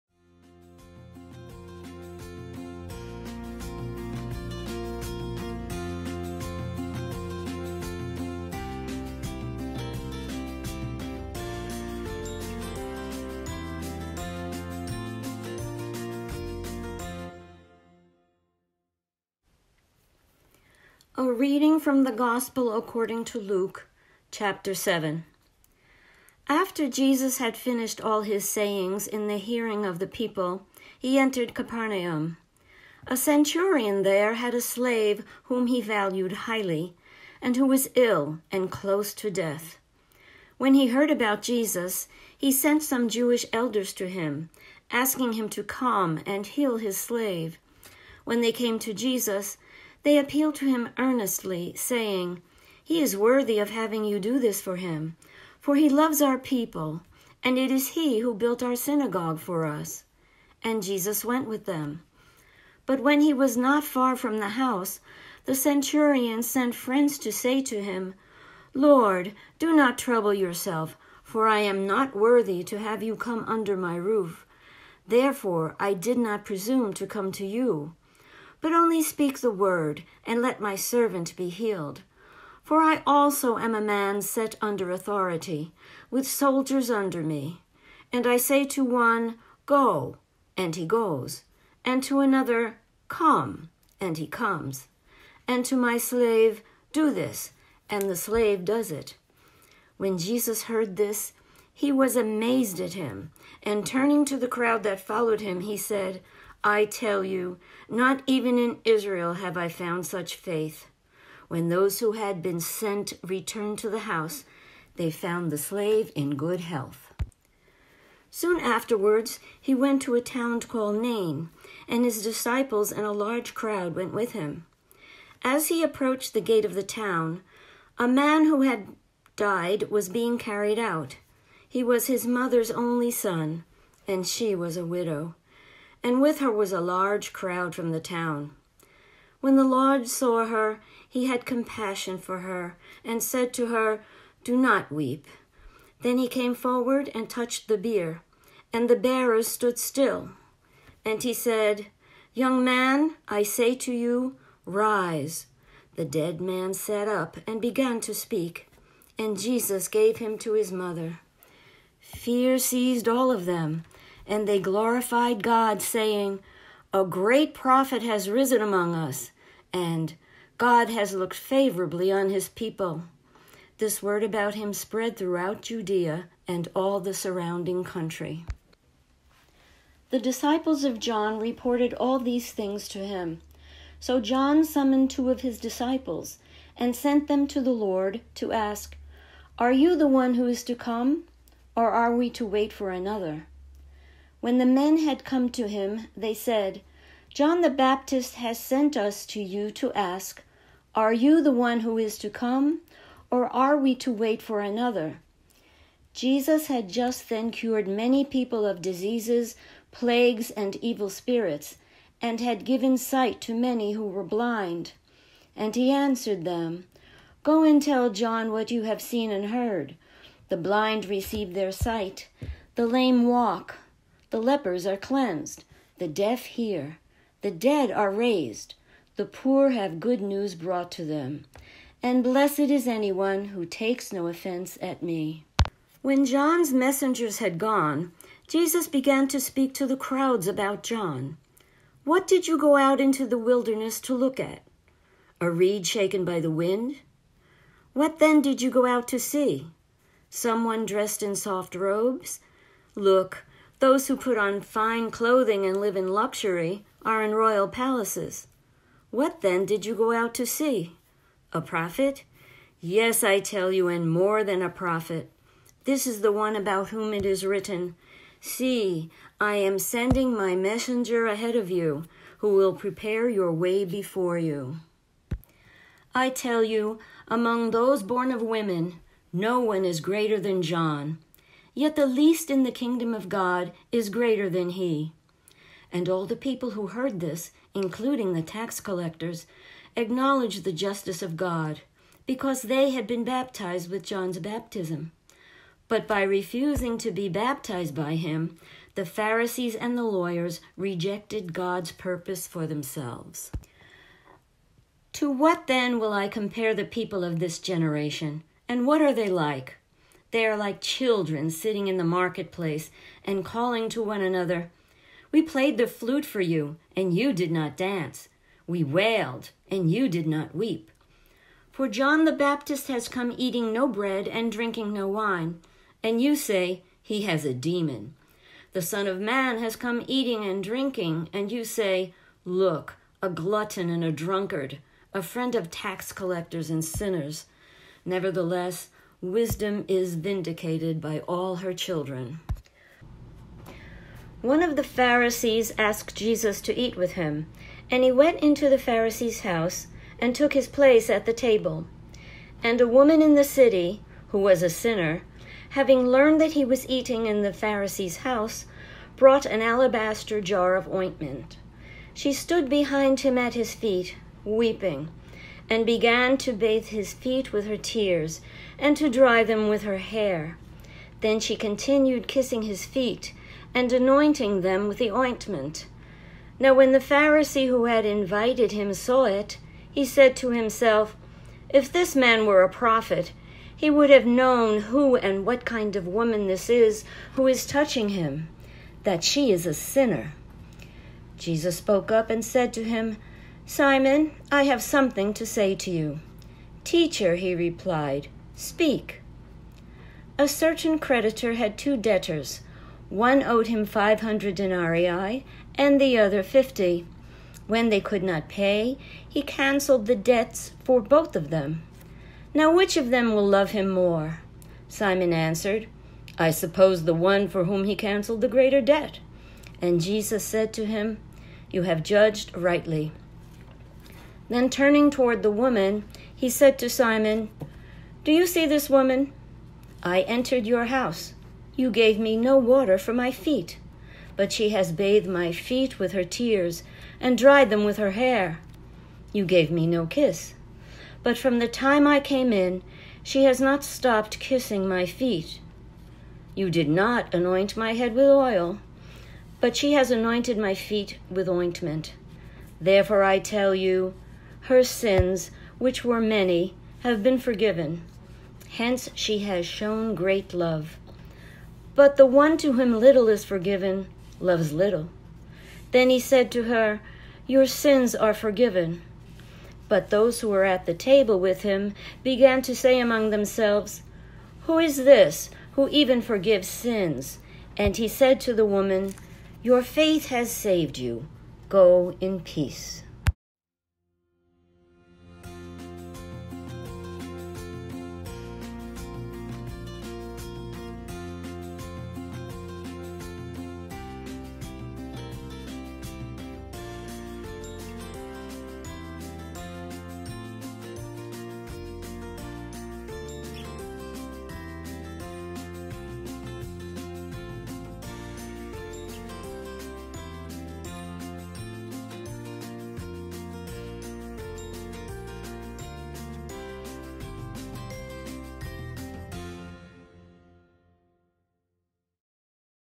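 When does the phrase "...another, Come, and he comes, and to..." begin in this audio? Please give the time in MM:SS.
01:32.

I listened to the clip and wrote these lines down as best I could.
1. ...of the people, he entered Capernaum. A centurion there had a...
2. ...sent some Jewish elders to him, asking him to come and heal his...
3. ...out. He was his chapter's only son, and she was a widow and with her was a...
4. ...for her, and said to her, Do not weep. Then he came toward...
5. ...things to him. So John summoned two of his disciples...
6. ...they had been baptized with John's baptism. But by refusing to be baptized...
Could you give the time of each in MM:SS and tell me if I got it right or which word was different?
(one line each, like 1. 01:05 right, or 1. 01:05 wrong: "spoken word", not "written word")
1. 00:29 right
2. 00:42 right
3. 02:10 wrong: "mother", not "chapter"
4. 02:22 wrong: "forward", not "toward"
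5. 03:02 right
6. 04:52 right.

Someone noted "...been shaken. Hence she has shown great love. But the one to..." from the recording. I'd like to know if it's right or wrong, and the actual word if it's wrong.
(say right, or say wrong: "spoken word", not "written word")
wrong: "forgiven", not "shaken".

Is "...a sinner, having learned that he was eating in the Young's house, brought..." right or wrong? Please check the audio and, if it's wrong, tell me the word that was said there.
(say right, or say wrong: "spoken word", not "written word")
wrong: "Pharisee", not "Young".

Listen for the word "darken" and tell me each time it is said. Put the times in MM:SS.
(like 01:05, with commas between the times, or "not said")
not said.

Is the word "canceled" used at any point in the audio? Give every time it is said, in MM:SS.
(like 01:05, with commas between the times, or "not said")
06:49, 06:57.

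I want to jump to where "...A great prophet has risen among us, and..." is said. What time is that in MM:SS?
02:46.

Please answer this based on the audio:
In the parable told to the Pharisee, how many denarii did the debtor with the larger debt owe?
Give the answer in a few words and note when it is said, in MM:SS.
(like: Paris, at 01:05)
500, at 06:43.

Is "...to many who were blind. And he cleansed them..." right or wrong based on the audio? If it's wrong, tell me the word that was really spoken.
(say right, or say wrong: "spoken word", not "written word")
wrong: "answered", not "cleansed".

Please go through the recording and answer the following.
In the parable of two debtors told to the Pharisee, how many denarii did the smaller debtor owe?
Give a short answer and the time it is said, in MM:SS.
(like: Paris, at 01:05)
50, at 06:46.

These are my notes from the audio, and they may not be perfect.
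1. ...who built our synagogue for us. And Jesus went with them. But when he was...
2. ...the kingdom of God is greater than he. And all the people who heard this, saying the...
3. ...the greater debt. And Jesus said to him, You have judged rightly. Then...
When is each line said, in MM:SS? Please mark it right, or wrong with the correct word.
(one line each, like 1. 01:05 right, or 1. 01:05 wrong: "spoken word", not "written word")
1. 00:58 right
2. 04:42 wrong: "including", not "saying"
3. 06:58 right.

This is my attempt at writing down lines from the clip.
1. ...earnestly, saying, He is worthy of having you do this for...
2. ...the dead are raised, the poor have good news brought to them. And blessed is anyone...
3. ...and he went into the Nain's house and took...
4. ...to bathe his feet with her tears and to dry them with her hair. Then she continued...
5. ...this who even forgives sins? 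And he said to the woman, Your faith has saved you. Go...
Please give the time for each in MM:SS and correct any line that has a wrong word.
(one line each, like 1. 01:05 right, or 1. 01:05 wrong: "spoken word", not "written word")
1. 00:50 right
2. 03:47 right
3. 05:47 wrong: "Pharisee", not "Nain"
4. 06:06 right
5. 07:54 right.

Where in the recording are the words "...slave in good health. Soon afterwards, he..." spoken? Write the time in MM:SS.
01:55.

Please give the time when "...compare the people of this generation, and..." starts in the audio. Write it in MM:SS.
05:06.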